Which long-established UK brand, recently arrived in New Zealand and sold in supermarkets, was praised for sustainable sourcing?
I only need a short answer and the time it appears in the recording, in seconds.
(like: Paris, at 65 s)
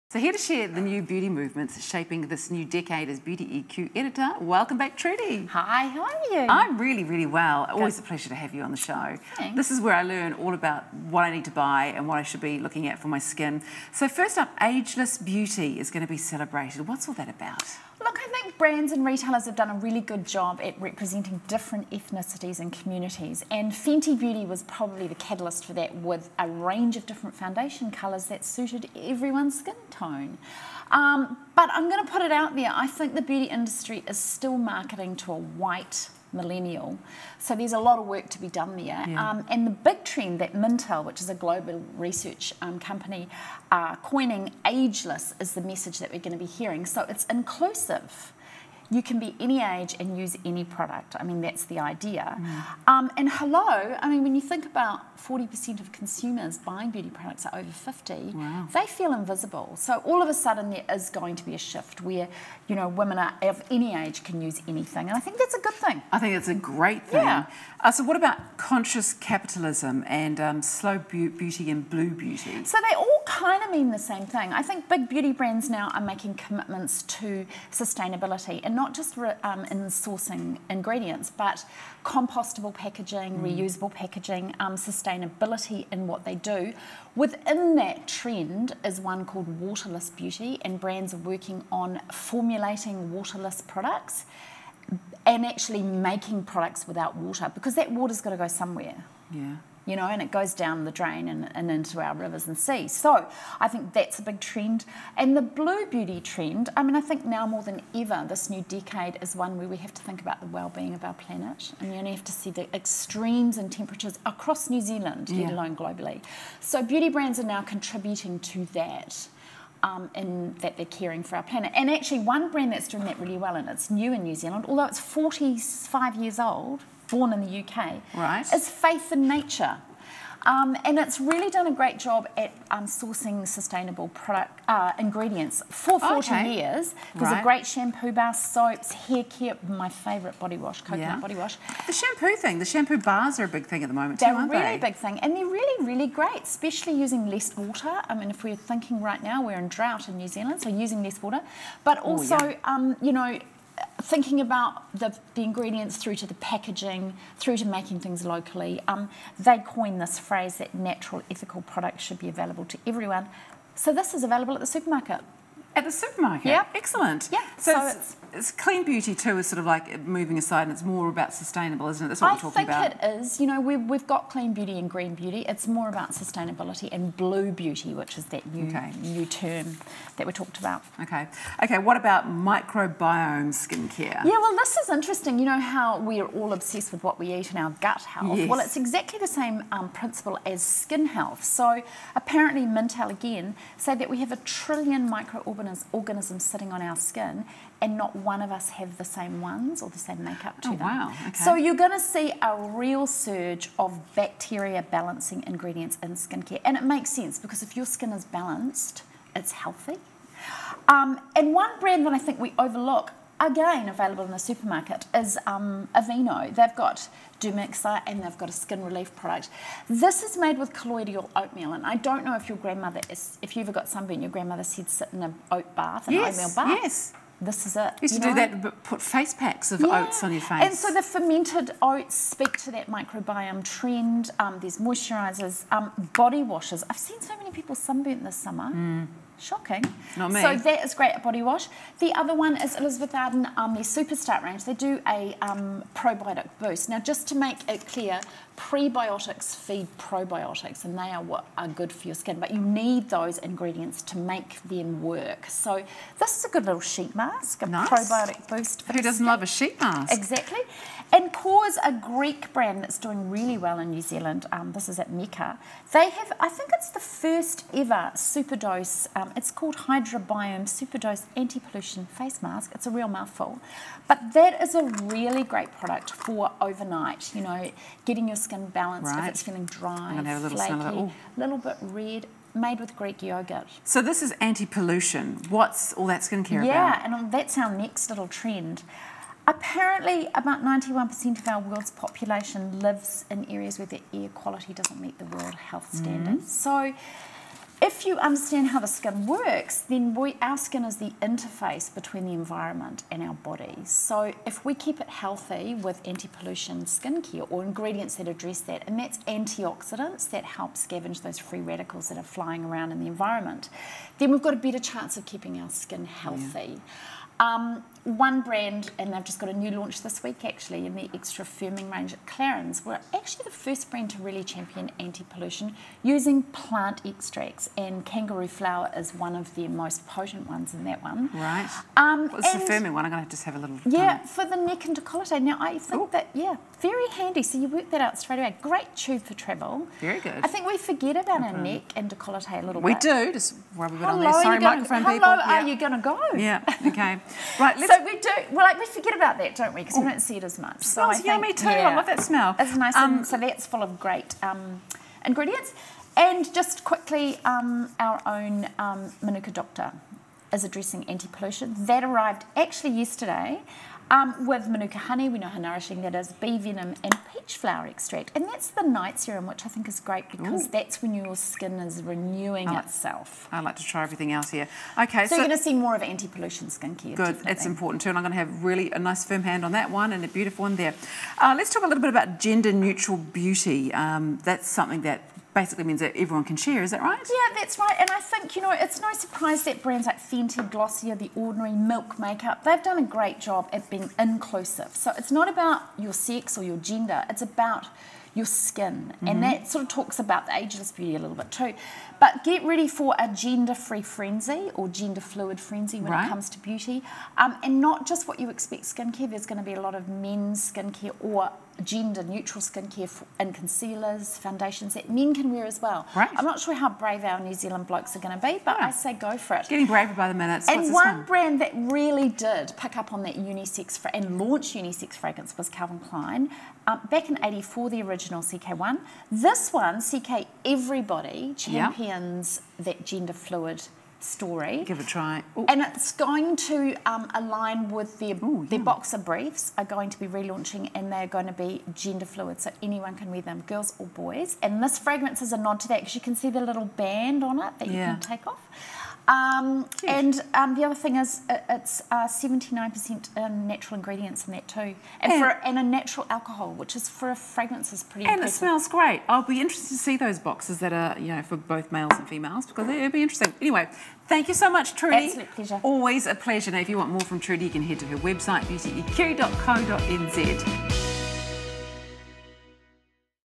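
Faith in Nature, at 128 s.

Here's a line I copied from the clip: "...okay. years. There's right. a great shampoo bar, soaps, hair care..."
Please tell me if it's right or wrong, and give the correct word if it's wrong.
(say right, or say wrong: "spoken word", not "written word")
right.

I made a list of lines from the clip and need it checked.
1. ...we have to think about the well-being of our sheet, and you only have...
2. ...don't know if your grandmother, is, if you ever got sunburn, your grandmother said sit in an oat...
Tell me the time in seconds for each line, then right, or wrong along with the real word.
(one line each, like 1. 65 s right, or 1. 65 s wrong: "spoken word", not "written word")
1. 109 s wrong: "planet", not "sheet"
2. 221 s right.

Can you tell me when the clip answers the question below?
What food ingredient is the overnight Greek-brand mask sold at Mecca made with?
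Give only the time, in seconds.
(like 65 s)
282 s.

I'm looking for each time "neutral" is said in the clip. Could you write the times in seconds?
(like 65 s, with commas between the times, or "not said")
382 s, 412 s.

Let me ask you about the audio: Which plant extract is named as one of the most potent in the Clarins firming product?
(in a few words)
Kangaroo flower.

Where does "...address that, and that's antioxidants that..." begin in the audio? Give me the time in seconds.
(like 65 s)
308 s.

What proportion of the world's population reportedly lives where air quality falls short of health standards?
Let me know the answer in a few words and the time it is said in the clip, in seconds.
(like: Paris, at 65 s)
91%, at 290 s.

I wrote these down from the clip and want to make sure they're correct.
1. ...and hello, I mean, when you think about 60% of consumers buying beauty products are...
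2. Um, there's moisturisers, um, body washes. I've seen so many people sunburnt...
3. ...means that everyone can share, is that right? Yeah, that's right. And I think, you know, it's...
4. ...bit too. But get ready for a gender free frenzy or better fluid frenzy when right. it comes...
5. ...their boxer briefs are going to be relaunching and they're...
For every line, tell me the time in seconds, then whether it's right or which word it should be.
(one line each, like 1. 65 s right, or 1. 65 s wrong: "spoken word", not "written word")
1. 53 s wrong: "40", not "60"
2. 234 s right
3. 385 s right
4. 401 s wrong: "gender", not "better"
5. 438 s right.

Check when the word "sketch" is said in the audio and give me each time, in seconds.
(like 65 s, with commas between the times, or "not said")
not said.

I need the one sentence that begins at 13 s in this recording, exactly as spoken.
So first up, Ageless Beauty is going to be celebrated.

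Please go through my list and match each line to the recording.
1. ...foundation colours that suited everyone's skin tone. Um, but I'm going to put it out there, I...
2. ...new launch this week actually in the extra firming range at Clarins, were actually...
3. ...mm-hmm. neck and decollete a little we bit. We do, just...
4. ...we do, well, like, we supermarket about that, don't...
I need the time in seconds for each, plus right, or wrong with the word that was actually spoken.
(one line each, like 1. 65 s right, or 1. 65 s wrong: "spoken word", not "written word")
1. 27 s right
2. 319 s right
3. 341 s right
4. 348 s wrong: "forget", not "supermarket".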